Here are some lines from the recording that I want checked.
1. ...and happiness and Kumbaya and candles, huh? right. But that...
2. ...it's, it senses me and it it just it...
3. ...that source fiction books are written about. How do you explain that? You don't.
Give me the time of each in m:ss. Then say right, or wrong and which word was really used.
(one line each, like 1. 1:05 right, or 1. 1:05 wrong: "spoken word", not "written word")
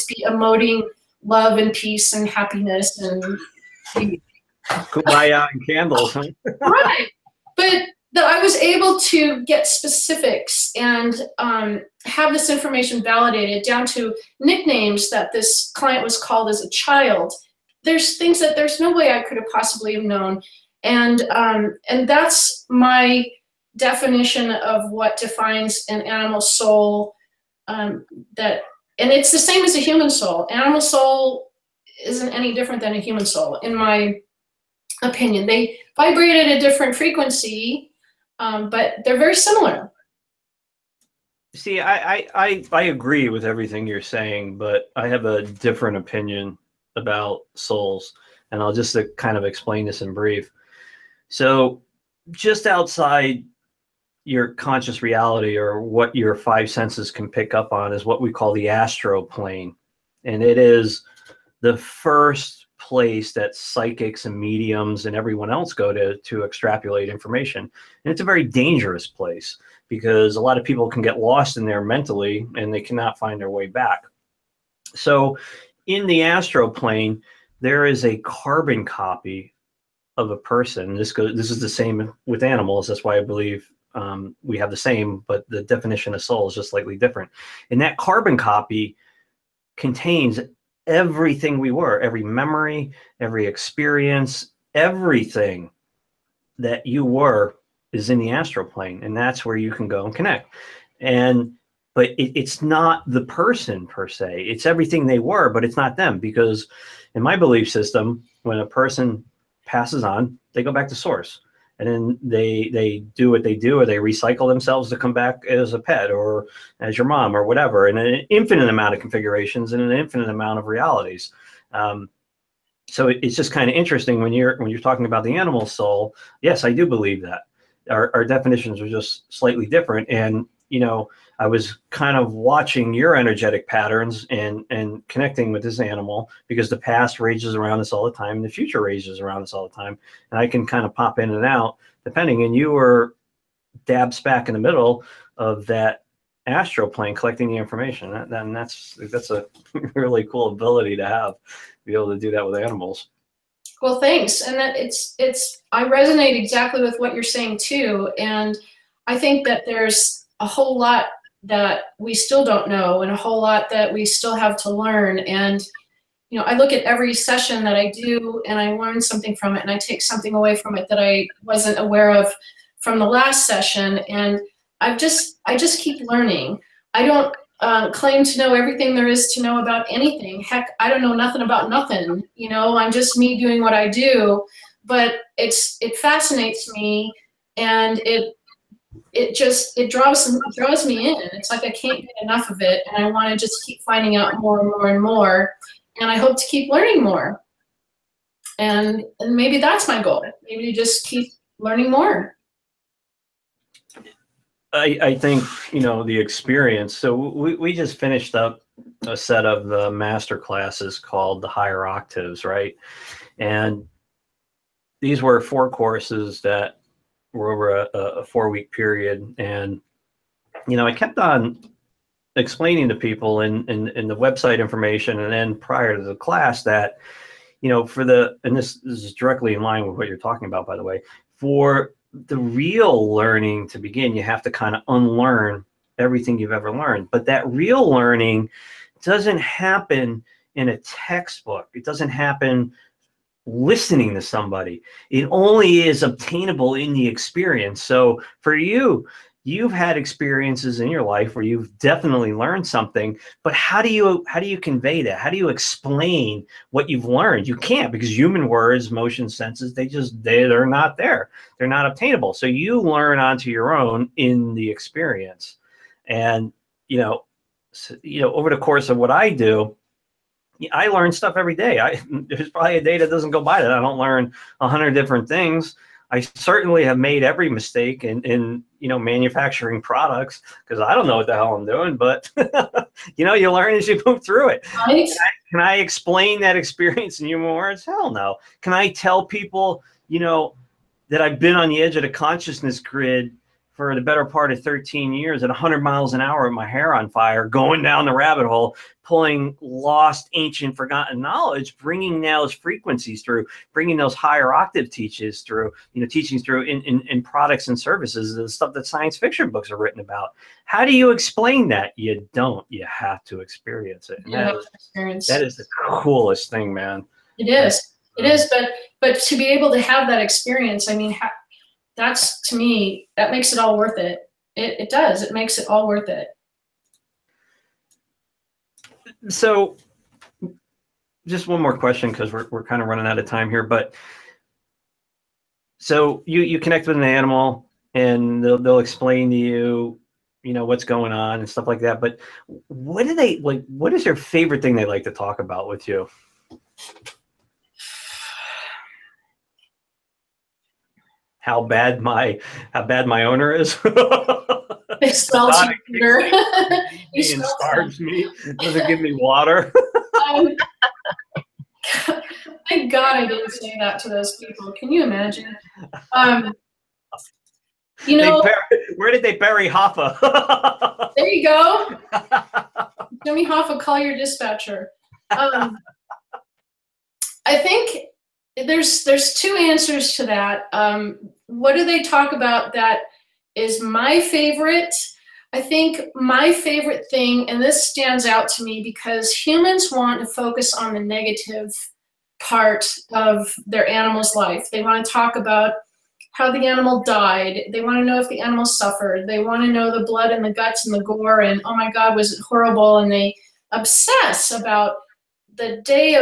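1. 0:02 right
2. 3:05 wrong: "fascinates", not "senses"
3. 5:08 wrong: "science", not "source".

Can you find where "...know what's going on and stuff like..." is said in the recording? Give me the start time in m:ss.
5:40.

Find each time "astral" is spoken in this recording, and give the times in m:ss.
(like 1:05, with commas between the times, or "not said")
0:58, 1:16, 1:38, 2:26.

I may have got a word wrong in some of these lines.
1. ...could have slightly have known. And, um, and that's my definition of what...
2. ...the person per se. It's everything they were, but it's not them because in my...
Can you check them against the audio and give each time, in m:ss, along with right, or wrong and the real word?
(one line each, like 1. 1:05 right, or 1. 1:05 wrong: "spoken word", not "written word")
1. 0:19 wrong: "possibly", not "slightly"
2. 1:43 right.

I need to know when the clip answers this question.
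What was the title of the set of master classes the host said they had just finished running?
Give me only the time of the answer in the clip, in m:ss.
3:31.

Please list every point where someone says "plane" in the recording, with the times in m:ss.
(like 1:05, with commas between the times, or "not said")
0:59, 1:16, 1:38, 2:26.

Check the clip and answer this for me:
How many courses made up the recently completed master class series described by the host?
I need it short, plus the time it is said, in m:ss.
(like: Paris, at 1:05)
4, at 3:35.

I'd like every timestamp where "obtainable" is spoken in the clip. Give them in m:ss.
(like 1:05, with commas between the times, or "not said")
4:06, 4:21.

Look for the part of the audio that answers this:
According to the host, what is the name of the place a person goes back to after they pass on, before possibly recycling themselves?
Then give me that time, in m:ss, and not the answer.
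1:50.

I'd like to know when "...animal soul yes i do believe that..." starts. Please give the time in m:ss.
2:05.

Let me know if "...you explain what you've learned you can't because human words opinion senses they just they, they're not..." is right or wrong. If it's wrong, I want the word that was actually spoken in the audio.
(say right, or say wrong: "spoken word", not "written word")
wrong: "motion", not "opinion".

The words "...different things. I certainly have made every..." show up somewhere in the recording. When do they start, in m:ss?
4:34.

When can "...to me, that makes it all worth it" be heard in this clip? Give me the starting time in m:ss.
5:22.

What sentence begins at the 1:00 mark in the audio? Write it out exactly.
And it is the first place that psychics and mediums and everyone else go to to extrapolate information.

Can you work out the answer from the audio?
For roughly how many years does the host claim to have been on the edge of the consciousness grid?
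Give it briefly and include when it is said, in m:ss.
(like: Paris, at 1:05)
13, at 4:54.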